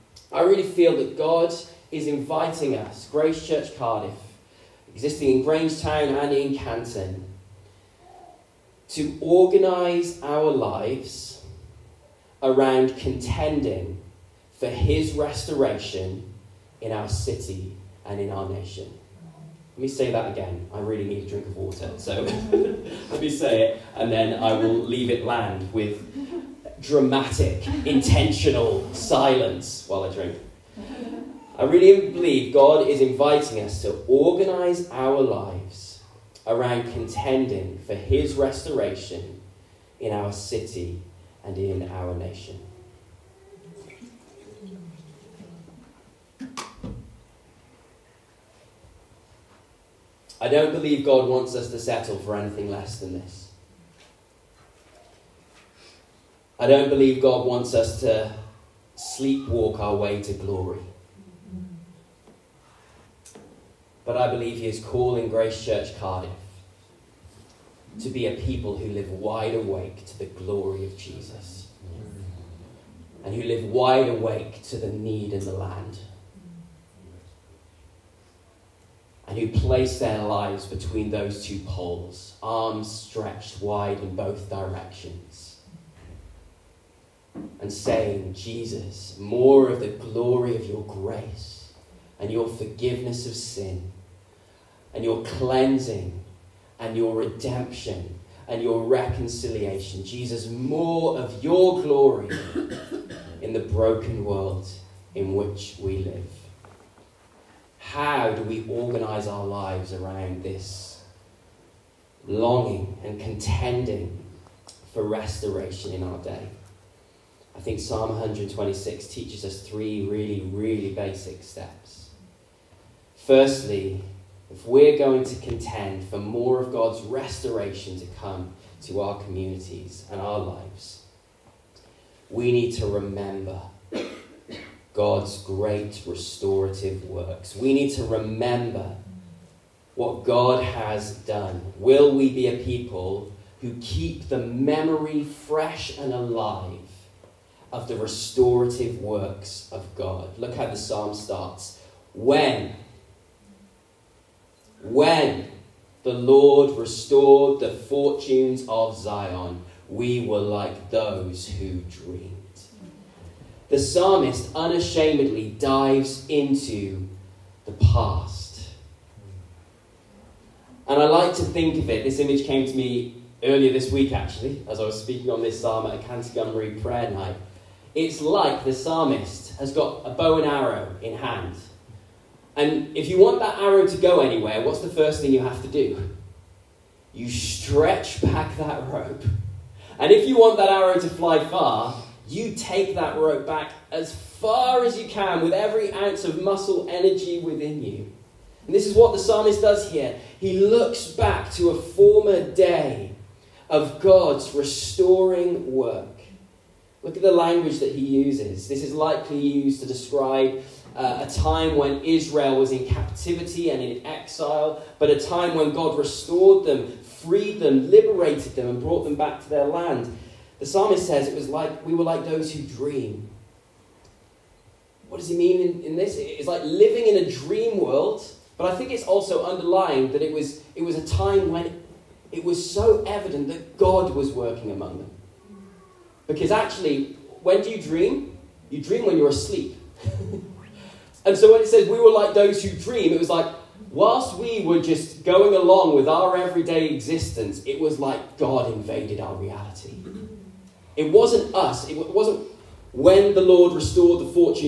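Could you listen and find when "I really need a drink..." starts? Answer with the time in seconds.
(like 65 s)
20 s.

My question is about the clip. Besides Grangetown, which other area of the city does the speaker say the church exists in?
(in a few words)
Canton.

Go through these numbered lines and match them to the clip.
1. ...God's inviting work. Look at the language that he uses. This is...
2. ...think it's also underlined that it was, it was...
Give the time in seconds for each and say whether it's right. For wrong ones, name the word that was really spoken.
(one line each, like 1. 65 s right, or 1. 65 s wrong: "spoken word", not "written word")
1. 203 s wrong: "restoring", not "inviting"
2. 228 s right.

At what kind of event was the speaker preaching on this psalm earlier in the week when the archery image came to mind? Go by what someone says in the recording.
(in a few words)
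Canterbury prayer night.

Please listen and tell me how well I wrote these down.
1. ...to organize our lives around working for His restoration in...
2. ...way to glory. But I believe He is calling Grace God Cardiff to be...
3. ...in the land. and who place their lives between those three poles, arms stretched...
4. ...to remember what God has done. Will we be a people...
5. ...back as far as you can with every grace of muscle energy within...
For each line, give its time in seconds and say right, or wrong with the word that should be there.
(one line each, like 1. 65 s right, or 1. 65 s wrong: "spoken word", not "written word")
1. 33 s wrong: "contending", not "working"
2. 59 s wrong: "Church", not "God"
3. 75 s wrong: "two", not "three"
4. 137 s right
5. 193 s wrong: "ounce", not "grace".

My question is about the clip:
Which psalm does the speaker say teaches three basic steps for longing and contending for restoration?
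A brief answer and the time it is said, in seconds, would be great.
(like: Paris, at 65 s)
Psalm 126, at 117 s.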